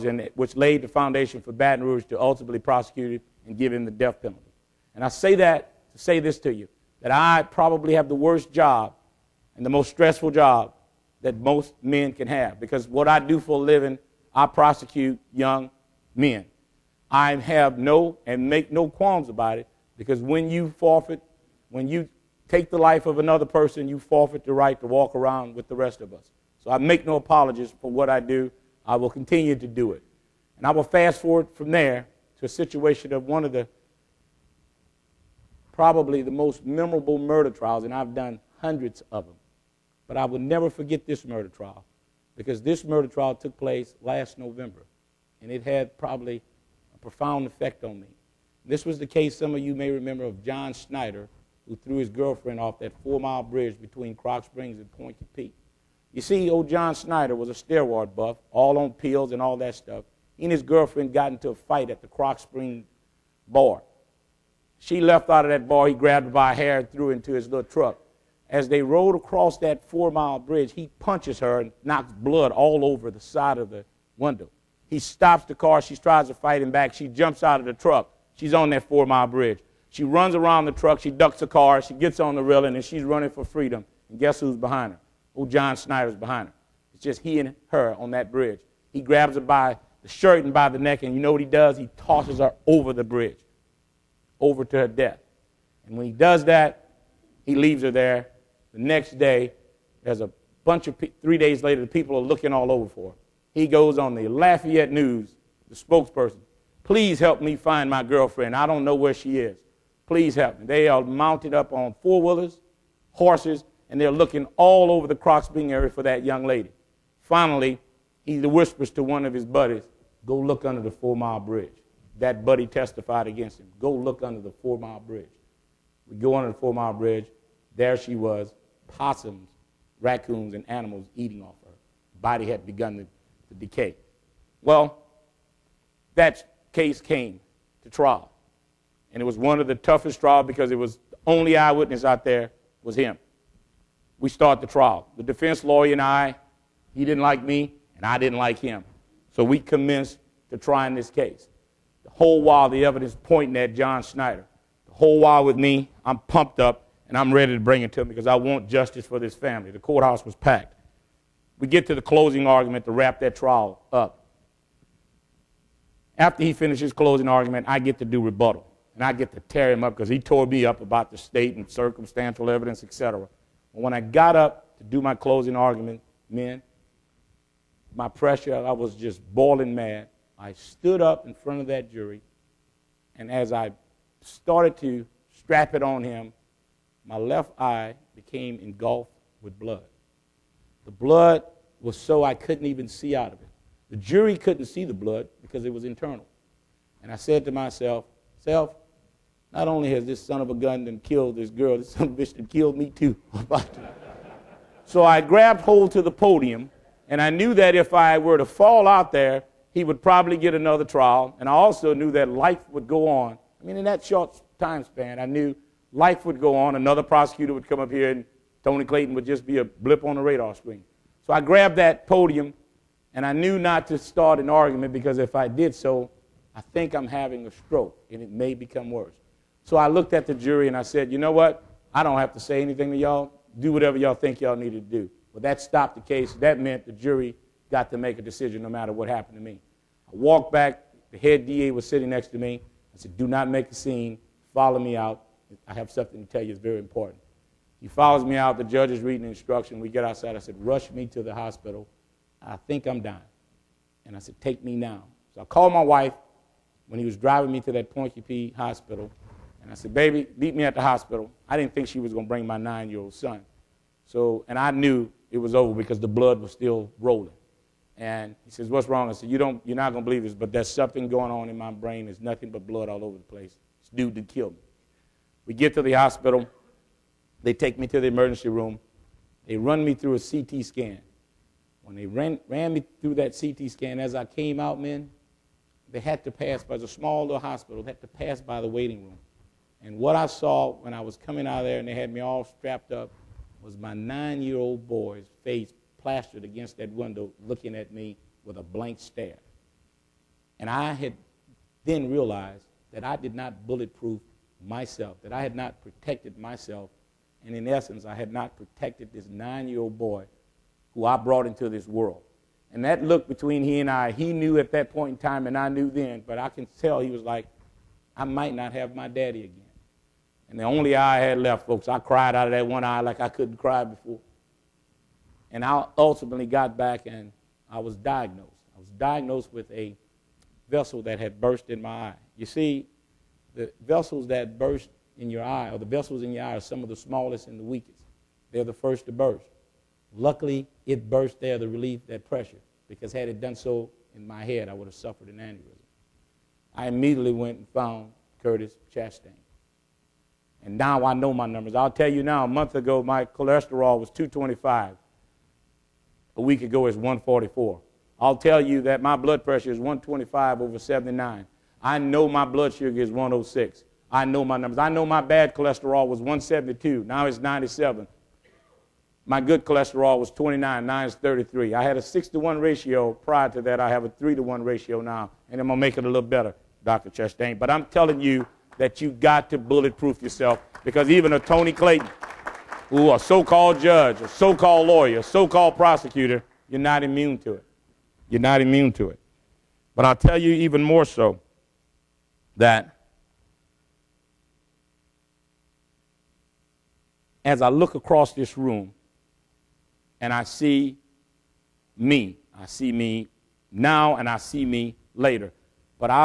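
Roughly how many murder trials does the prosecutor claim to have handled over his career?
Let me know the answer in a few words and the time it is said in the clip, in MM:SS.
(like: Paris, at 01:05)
hundreds, at 00:38.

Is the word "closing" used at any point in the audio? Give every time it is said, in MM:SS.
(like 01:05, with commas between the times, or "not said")
02:42, 02:46, 02:55.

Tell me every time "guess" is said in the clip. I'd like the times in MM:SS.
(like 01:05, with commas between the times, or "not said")
01:24.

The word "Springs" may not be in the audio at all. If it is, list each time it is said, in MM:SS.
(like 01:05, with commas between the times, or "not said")
00:54, 01:02.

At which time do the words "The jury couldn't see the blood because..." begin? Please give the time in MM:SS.
03:13.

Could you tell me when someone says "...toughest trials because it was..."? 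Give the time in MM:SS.
02:19.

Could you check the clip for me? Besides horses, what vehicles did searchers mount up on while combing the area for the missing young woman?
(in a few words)
four wheelers.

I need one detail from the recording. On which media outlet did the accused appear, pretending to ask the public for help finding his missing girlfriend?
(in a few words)
Lafayette News.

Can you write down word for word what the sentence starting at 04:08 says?
The judge is reading the instruction.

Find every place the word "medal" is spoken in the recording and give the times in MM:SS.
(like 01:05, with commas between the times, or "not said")
not said.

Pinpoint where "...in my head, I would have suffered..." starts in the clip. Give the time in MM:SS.
05:44.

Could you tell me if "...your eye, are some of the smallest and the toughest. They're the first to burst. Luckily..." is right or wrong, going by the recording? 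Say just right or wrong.
wrong.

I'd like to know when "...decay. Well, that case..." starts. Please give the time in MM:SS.
02:13.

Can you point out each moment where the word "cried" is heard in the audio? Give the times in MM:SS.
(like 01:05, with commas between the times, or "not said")
05:21.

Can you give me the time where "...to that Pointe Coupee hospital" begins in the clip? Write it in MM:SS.
04:17.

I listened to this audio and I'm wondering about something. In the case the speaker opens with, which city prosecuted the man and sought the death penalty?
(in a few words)
Baton Rouge.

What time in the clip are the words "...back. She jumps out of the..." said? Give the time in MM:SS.
01:16.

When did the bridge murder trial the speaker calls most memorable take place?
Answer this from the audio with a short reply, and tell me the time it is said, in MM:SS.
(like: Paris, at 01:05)
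last November, at 00:44.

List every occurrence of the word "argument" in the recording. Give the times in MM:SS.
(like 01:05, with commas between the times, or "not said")
02:42, 02:47, 02:55, 03:44.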